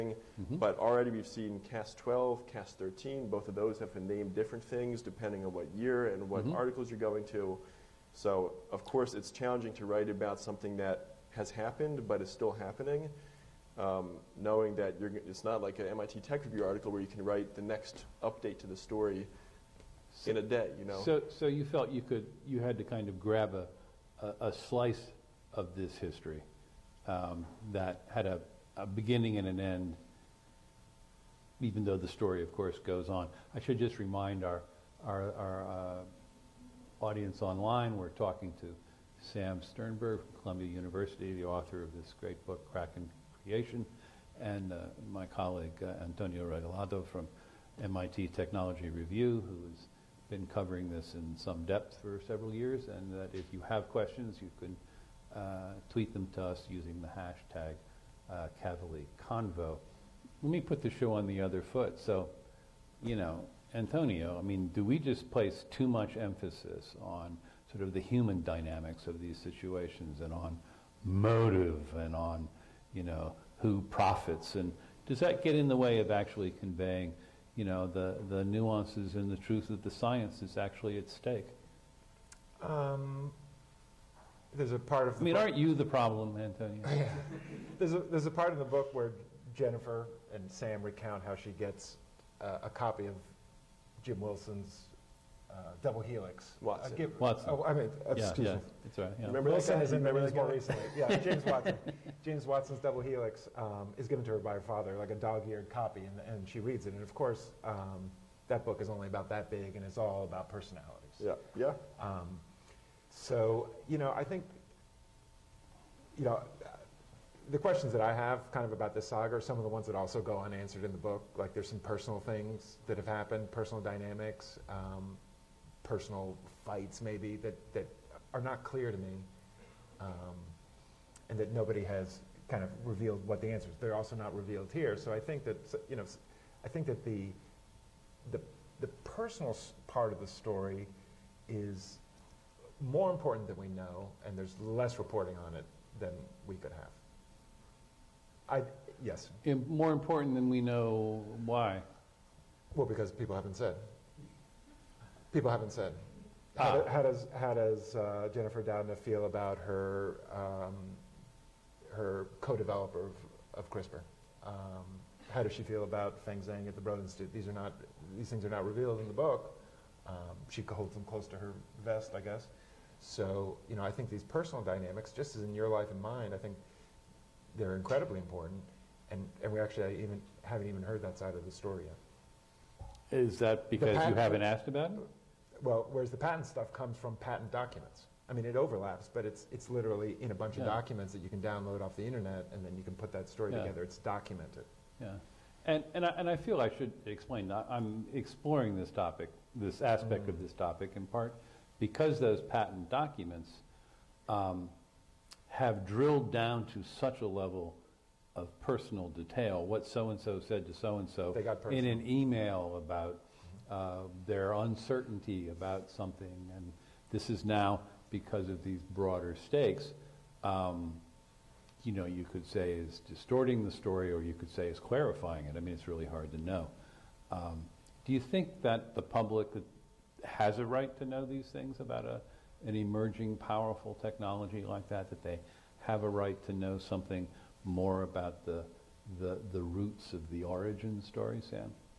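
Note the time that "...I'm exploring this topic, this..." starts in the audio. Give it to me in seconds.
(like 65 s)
197 s.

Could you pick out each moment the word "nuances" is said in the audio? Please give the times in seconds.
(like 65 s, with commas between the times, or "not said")
78 s.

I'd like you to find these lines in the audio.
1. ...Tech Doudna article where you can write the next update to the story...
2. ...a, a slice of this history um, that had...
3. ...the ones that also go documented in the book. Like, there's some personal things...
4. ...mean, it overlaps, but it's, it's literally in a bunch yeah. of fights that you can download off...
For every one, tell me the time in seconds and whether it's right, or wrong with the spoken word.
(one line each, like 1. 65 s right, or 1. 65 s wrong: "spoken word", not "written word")
1. 16 s wrong: "Review", not "Doudna"
2. 24 s right
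3. 119 s wrong: "unanswered", not "documented"
4. 188 s wrong: "documents", not "fights".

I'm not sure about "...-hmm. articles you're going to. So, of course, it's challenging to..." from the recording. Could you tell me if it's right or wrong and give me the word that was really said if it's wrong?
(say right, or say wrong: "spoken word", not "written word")
right.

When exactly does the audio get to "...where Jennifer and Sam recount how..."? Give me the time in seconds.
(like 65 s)
88 s.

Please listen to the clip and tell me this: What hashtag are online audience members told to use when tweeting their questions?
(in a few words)
Cavalier Convo.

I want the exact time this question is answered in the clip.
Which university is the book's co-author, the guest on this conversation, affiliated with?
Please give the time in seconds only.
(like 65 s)
40 s.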